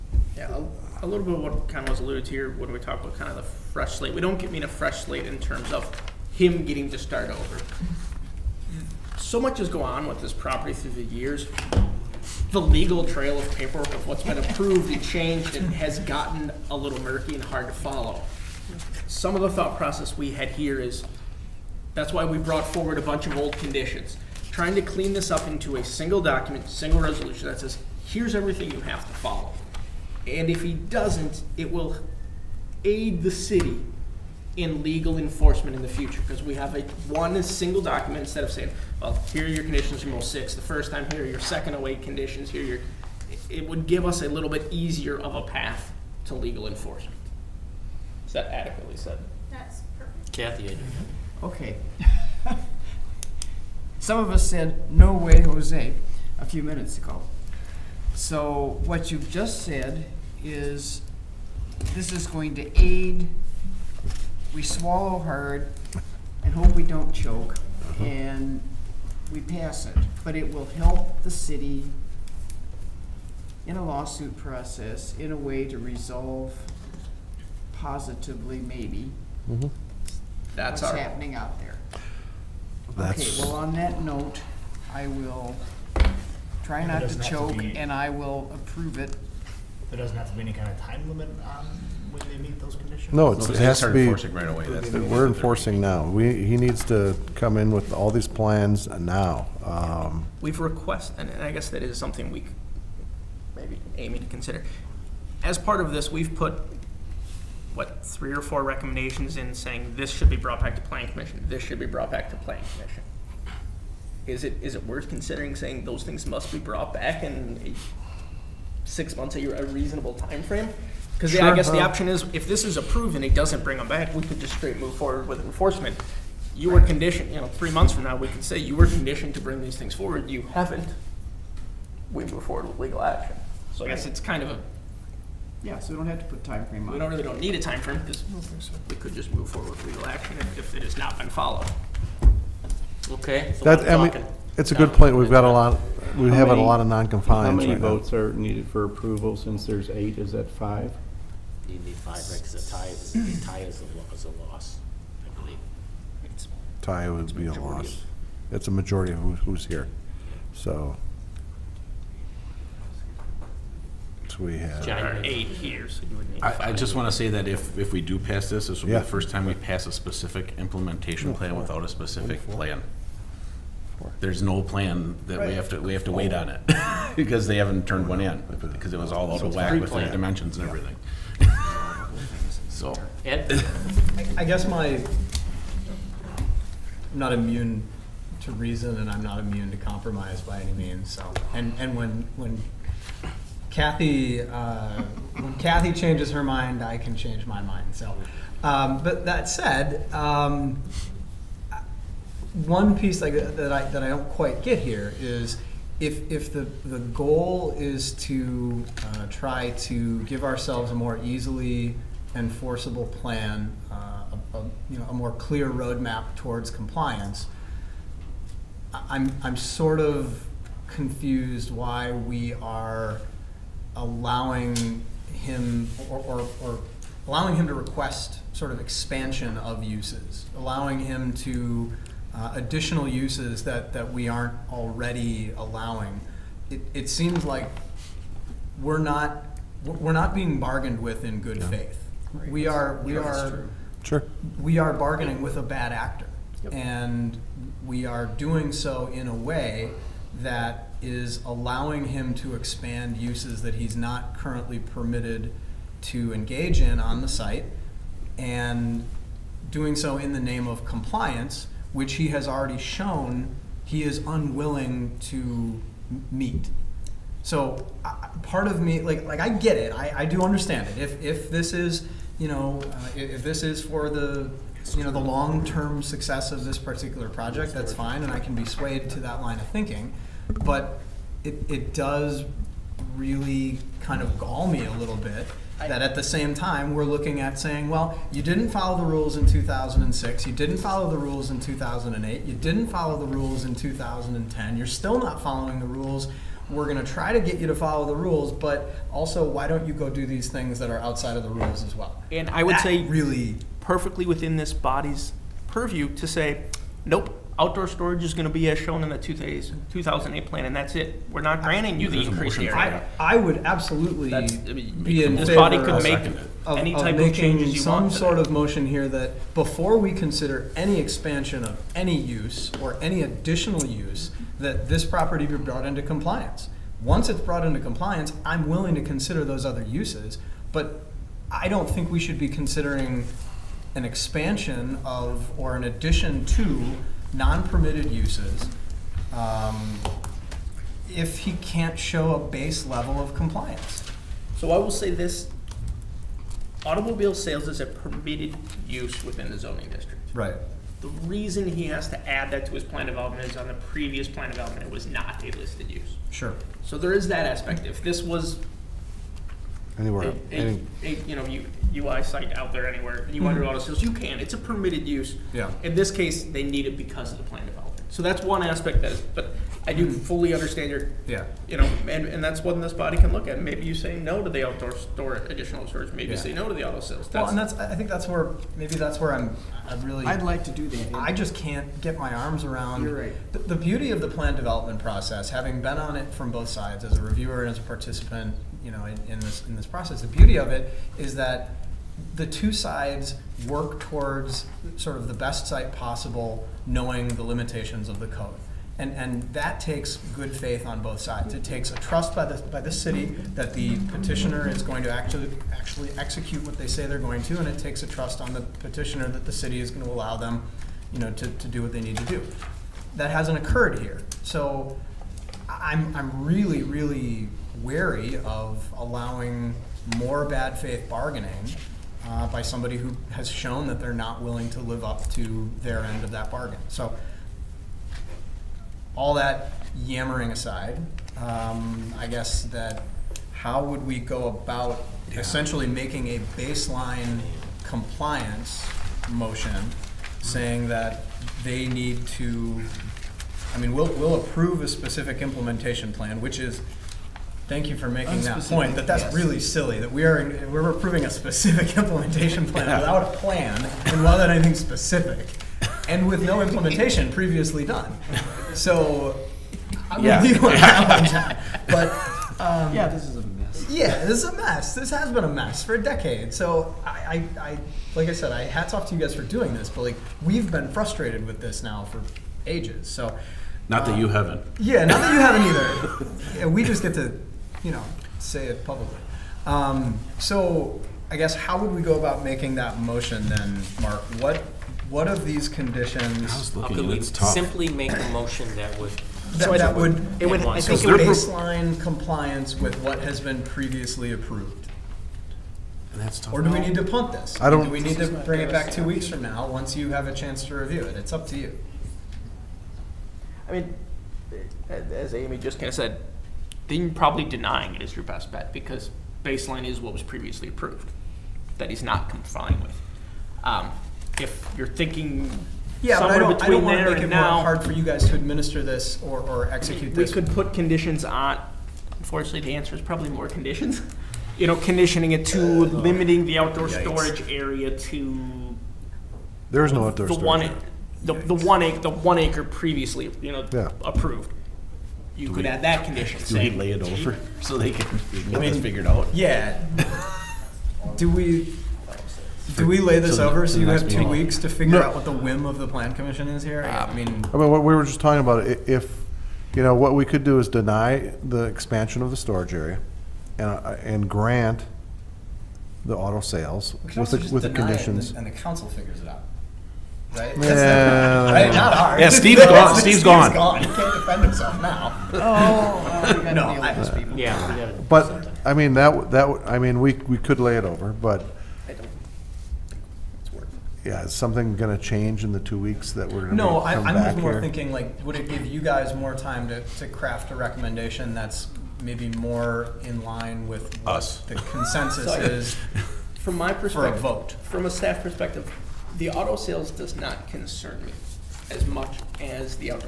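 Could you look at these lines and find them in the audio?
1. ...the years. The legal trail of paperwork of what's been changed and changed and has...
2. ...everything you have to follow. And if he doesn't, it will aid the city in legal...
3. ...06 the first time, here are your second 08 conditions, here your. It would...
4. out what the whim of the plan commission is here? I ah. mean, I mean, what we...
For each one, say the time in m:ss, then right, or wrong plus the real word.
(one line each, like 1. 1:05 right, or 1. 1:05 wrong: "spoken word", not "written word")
1. 0:10 wrong: "approved", not "changed"
2. 0:28 right
3. 0:40 right
4. 9:05 right.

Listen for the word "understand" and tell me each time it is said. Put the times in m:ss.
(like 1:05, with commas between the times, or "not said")
4:30, 6:10.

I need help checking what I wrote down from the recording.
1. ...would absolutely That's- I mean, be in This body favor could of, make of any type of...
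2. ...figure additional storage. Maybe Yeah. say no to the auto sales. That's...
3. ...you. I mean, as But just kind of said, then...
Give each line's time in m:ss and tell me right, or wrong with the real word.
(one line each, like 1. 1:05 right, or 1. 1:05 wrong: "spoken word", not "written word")
1. 5:13 right
2. 6:14 wrong: "store", not "figure"
3. 8:21 wrong: "Amy", not "But".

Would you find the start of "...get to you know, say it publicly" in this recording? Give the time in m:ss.
7:57.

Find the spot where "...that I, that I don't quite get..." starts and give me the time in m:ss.
3:23.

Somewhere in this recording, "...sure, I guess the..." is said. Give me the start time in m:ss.
2:01.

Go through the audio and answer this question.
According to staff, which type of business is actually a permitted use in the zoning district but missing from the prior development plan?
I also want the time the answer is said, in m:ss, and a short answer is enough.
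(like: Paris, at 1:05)
automobile sales, at 5:46.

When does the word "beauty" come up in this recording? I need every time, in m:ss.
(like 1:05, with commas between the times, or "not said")
6:23, 6:30.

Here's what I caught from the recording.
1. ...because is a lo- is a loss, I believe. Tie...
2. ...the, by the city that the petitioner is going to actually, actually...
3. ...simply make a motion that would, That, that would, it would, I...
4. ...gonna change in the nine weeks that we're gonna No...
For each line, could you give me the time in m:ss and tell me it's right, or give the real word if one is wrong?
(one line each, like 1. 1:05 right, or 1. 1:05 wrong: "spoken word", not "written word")
1. 2:32 right
2. 6:42 right
3. 8:07 right
4. 9:34 wrong: "two", not "nine".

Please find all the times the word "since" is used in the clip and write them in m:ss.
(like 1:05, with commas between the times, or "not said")
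2:29.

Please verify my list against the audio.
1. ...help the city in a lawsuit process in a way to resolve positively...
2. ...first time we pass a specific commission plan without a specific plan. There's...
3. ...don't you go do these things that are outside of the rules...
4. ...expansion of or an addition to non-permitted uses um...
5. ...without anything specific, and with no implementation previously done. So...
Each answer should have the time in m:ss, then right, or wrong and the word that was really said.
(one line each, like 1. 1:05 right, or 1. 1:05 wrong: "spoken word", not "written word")
1. 1:10 right
2. 2:49 wrong: "implementation", not "commission"
3. 4:59 right
4. 5:34 right
5. 7:34 right.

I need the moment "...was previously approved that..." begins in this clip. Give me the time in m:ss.
8:30.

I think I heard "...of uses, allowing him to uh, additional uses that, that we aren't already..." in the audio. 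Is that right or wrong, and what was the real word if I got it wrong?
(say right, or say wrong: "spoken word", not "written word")
right.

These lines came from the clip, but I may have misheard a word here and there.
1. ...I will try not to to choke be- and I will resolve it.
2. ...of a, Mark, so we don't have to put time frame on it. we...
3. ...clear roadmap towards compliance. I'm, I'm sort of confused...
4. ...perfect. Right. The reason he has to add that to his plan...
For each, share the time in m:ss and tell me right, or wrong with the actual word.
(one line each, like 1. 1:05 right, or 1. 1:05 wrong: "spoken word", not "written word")
1. 1:24 wrong: "approve", not "resolve"
2. 2:14 wrong: "Yeah", not "Mark"
3. 3:35 right
4. 5:49 wrong: "district", not "perfect".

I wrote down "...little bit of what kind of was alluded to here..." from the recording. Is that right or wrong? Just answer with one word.
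right.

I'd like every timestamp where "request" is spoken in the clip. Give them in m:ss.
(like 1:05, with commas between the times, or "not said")
1:40, 3:47.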